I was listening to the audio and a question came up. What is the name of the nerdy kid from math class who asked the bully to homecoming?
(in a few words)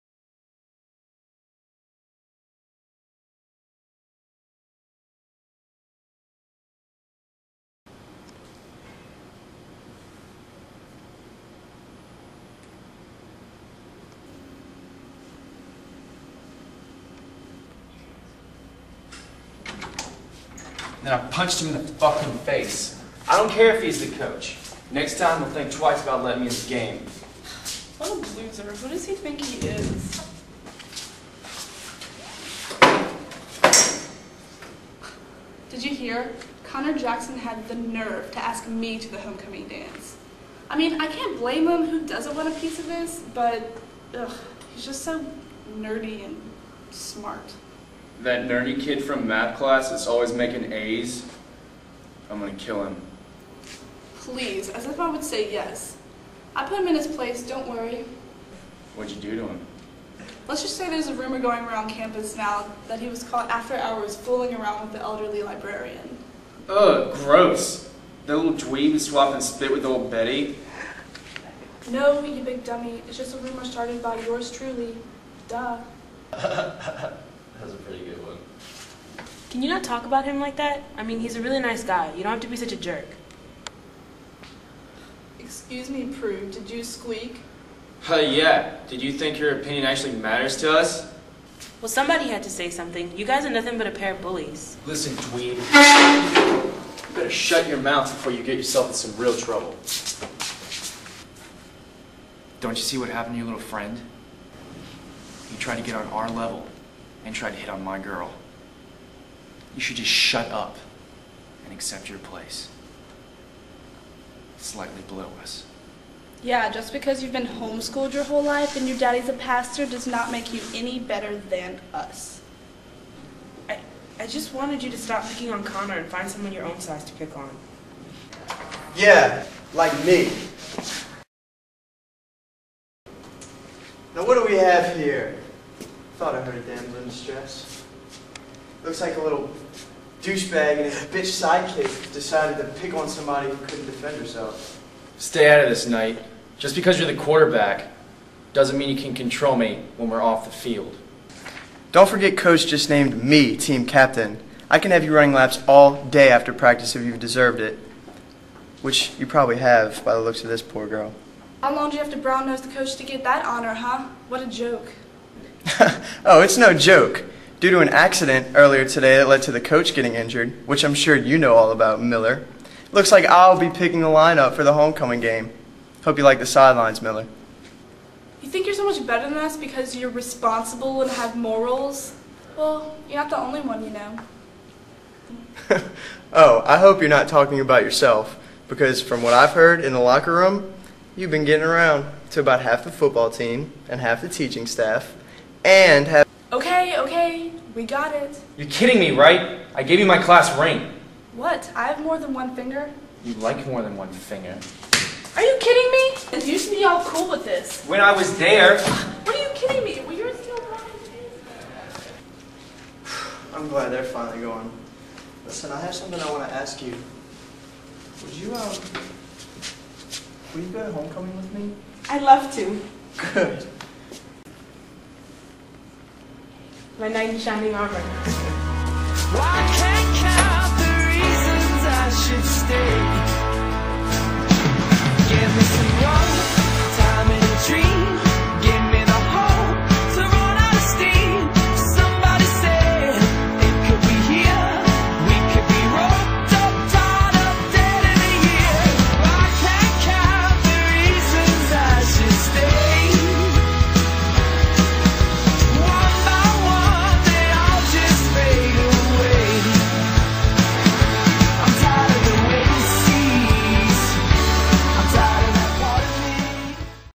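Connor Jackson.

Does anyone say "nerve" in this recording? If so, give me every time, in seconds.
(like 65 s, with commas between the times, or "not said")
37 s.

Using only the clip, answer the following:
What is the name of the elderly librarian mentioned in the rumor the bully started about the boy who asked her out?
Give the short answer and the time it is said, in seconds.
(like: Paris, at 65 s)
Betty, at 70 s.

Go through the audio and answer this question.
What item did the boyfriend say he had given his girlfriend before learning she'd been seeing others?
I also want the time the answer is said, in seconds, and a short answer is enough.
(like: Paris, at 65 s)
Class ring, at 200 s.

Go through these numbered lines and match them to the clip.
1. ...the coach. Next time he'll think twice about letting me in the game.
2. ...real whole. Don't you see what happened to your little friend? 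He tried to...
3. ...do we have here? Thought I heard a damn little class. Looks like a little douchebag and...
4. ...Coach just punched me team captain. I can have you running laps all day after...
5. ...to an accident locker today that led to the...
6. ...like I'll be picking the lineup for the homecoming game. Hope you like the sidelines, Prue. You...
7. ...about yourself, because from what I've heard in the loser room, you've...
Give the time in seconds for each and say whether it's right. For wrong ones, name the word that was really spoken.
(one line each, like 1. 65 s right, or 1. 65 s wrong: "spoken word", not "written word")
1. 24 s right
2. 99 s wrong: "trouble", not "whole"
3. 134 s wrong: "stress", not "class"
4. 152 s wrong: "named", not "punched"
5. 167 s wrong: "earlier", not "locker"
6. 173 s wrong: "Miller", not "Prue"
7. 187 s wrong: "locker", not "loser".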